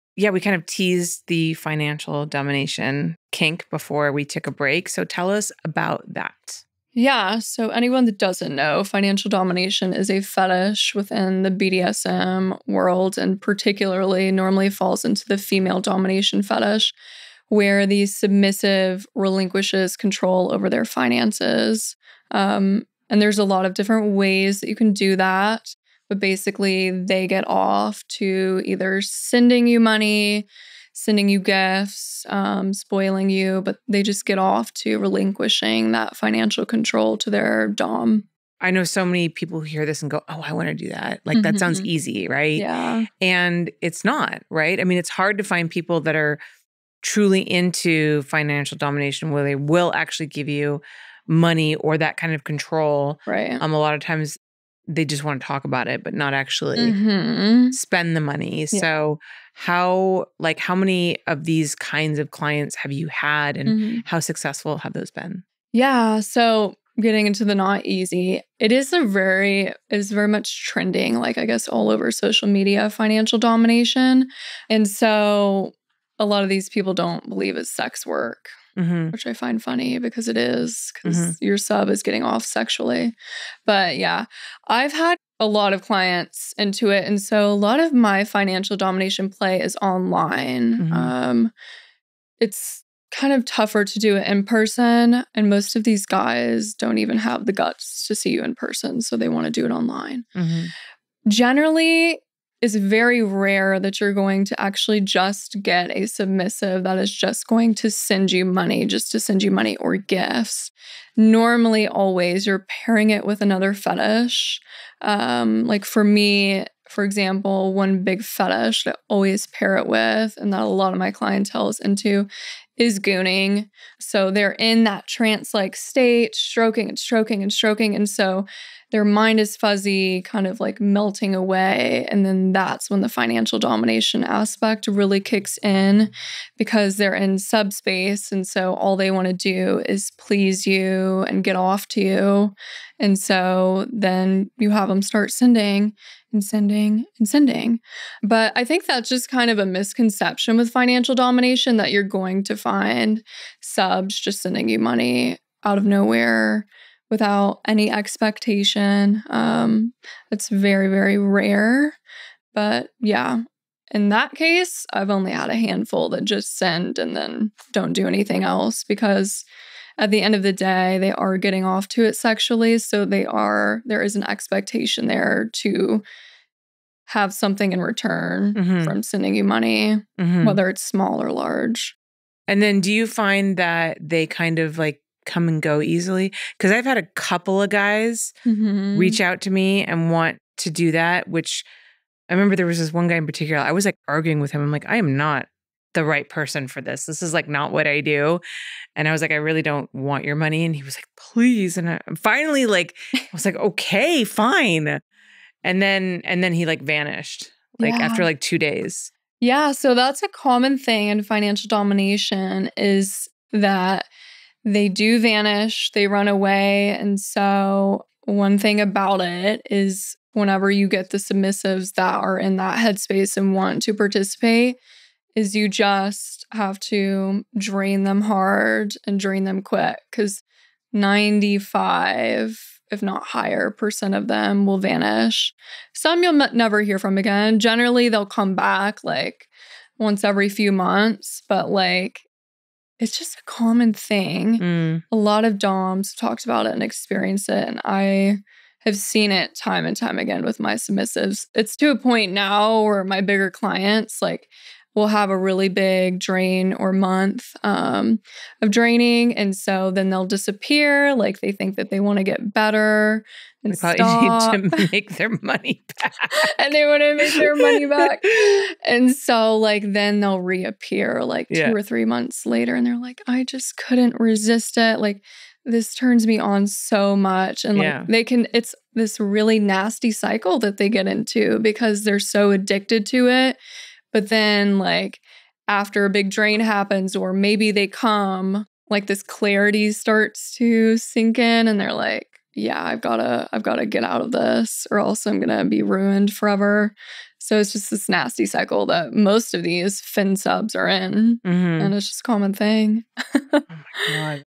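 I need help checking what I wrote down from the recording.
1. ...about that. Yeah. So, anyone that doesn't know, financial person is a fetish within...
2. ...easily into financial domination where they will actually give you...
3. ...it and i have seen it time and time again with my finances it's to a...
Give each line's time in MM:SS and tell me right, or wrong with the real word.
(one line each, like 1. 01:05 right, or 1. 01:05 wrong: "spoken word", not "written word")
1. 00:05 wrong: "domination", not "person"
2. 00:47 wrong: "truly", not "easily"
3. 04:07 wrong: "submissives", not "finances".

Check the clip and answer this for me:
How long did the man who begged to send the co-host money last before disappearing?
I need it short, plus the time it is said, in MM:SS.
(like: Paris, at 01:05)
2 days, at 03:28.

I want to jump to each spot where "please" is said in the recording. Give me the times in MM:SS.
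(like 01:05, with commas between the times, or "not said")
02:20, 03:21.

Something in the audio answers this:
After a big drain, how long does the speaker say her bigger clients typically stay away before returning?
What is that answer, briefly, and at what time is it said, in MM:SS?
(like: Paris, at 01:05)
2 or 3 months, at 04:31.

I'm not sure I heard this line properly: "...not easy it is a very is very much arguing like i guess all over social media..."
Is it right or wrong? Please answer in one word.
wrong.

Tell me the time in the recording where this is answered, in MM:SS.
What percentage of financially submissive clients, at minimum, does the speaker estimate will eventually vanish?
03:50.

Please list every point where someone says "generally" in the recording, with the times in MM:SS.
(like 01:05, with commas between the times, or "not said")
01:41, 03:57.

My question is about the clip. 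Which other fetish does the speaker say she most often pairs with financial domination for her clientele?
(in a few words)
gooning.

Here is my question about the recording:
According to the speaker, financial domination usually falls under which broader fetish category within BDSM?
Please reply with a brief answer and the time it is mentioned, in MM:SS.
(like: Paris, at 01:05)
female domination, at 00:15.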